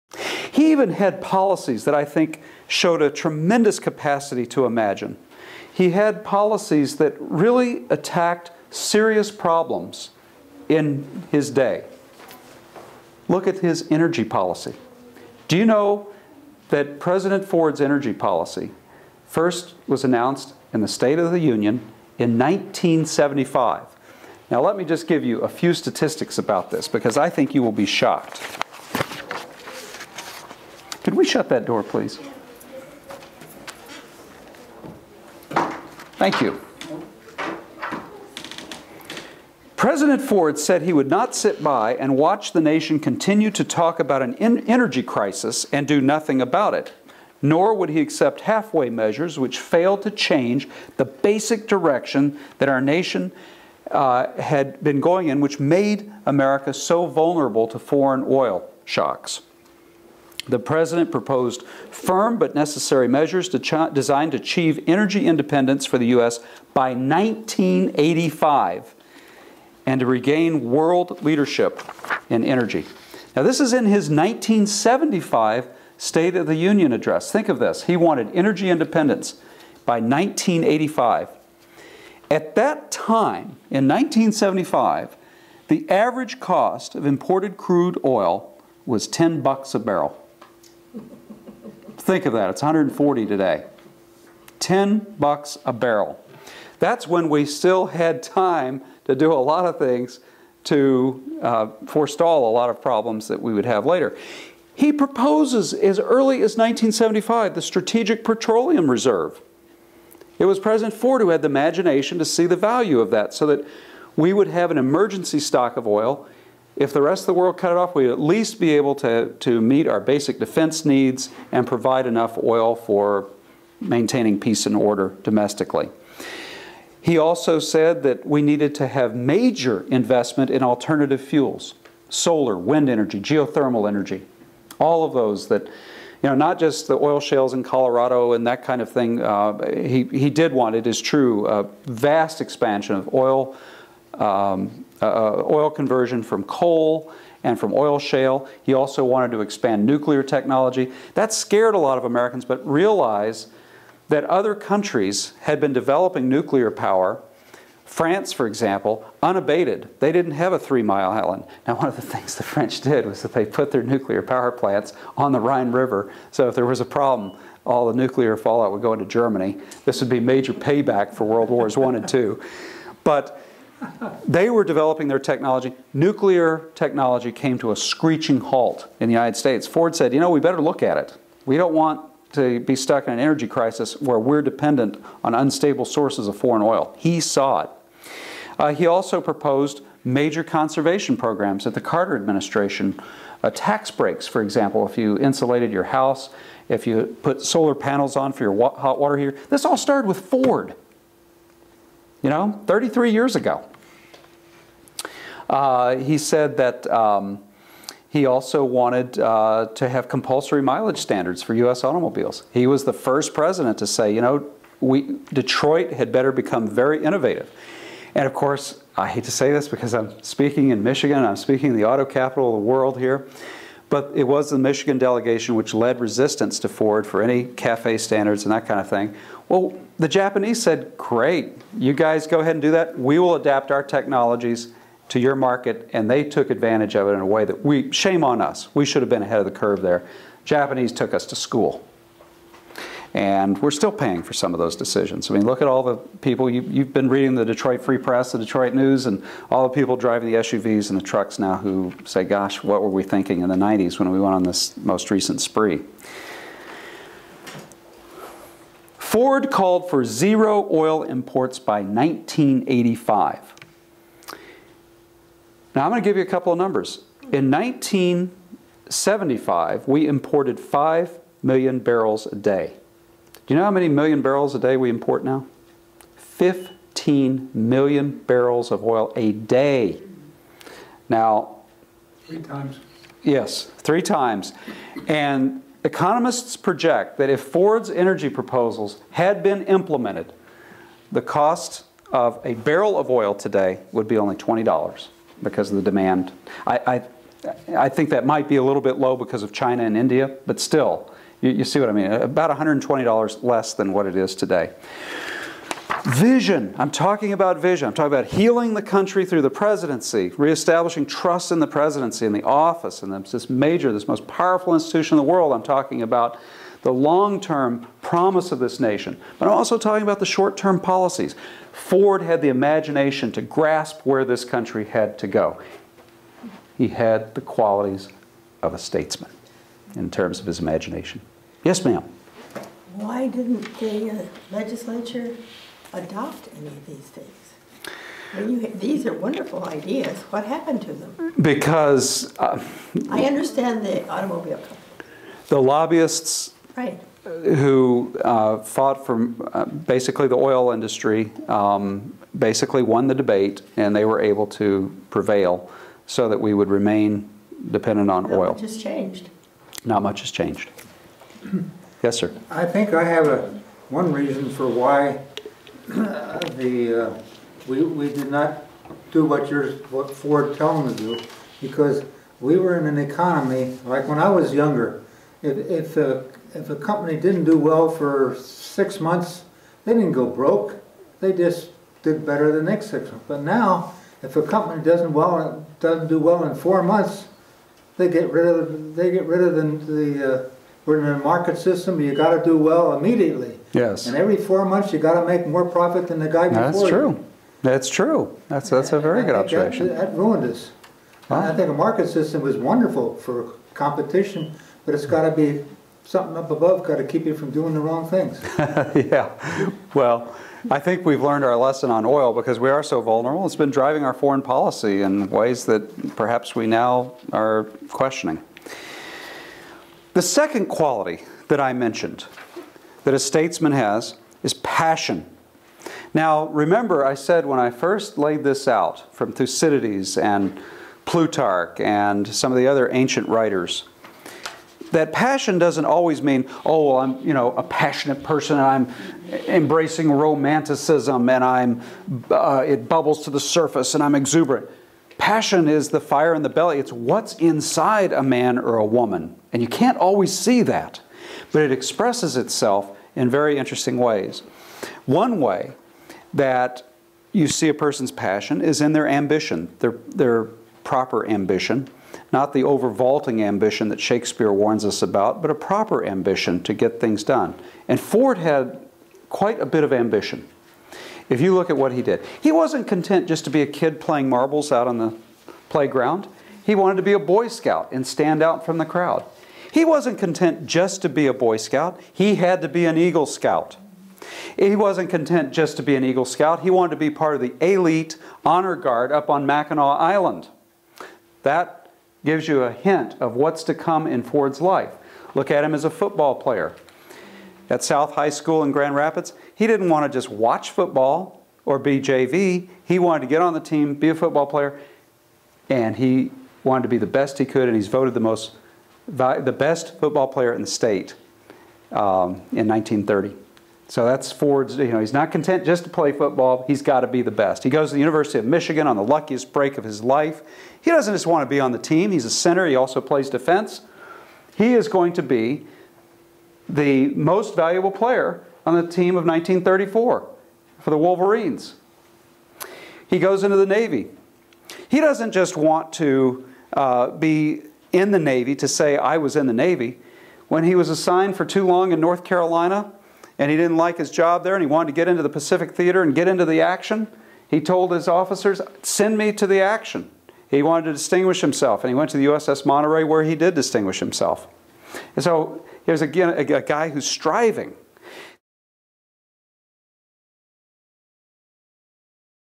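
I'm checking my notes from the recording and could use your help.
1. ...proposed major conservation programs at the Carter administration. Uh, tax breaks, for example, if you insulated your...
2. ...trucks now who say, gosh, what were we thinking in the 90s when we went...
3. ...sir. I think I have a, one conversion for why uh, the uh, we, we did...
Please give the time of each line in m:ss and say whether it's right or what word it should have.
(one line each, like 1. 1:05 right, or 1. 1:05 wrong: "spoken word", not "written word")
1. 3:09 right
2. 4:11 right
3. 6:02 wrong: "reason", not "conversion".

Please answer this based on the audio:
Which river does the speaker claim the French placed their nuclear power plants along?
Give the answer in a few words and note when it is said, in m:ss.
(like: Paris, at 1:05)
Rhine River, at 2:45.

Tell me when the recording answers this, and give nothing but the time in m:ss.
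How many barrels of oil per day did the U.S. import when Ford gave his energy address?
4:30.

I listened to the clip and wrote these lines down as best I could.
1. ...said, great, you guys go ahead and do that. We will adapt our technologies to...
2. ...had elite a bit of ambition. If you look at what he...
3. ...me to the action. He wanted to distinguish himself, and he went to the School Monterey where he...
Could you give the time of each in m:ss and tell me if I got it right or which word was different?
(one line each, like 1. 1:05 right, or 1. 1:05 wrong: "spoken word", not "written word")
1. 3:50 right
2. 7:48 wrong: "quite", not "elite"
3. 9:09 wrong: "USS", not "School".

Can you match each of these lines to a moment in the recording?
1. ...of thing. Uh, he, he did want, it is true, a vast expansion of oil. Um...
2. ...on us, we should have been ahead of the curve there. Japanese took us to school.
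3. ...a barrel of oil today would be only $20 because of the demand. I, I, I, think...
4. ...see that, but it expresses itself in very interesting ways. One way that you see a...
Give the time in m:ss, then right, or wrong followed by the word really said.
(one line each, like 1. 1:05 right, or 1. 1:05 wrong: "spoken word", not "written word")
1. 2:18 right
2. 3:58 right
3. 4:52 right
4. 7:30 right.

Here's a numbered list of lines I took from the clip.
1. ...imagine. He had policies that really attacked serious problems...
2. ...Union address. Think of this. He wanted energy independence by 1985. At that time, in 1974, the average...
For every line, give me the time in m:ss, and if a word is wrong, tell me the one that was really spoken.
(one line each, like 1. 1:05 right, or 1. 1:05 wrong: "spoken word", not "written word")
1. 0:04 right
2. 1:16 wrong: "1975", not "1974".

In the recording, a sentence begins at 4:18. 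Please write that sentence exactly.
Ford called for zero oil imports by 1985.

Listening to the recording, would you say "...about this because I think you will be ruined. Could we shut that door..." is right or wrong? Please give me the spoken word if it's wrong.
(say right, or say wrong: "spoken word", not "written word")
wrong: "shocked", not "ruined".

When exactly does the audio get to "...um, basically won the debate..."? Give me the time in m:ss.
5:51.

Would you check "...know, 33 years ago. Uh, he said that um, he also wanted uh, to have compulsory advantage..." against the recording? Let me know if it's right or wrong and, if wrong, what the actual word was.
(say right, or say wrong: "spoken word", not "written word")
wrong: "mileage", not "advantage".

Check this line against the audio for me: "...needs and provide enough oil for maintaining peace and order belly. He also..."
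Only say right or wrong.
wrong.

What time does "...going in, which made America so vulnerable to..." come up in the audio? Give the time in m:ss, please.
0:55.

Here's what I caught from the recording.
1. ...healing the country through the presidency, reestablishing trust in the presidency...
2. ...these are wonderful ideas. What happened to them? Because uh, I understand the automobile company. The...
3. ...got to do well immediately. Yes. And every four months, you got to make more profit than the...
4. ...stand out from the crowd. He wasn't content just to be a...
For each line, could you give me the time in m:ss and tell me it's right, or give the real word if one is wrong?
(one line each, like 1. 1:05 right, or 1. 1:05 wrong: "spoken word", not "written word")
1. 5:08 right
2. 5:38 right
3. 6:32 right
4. 7:58 right.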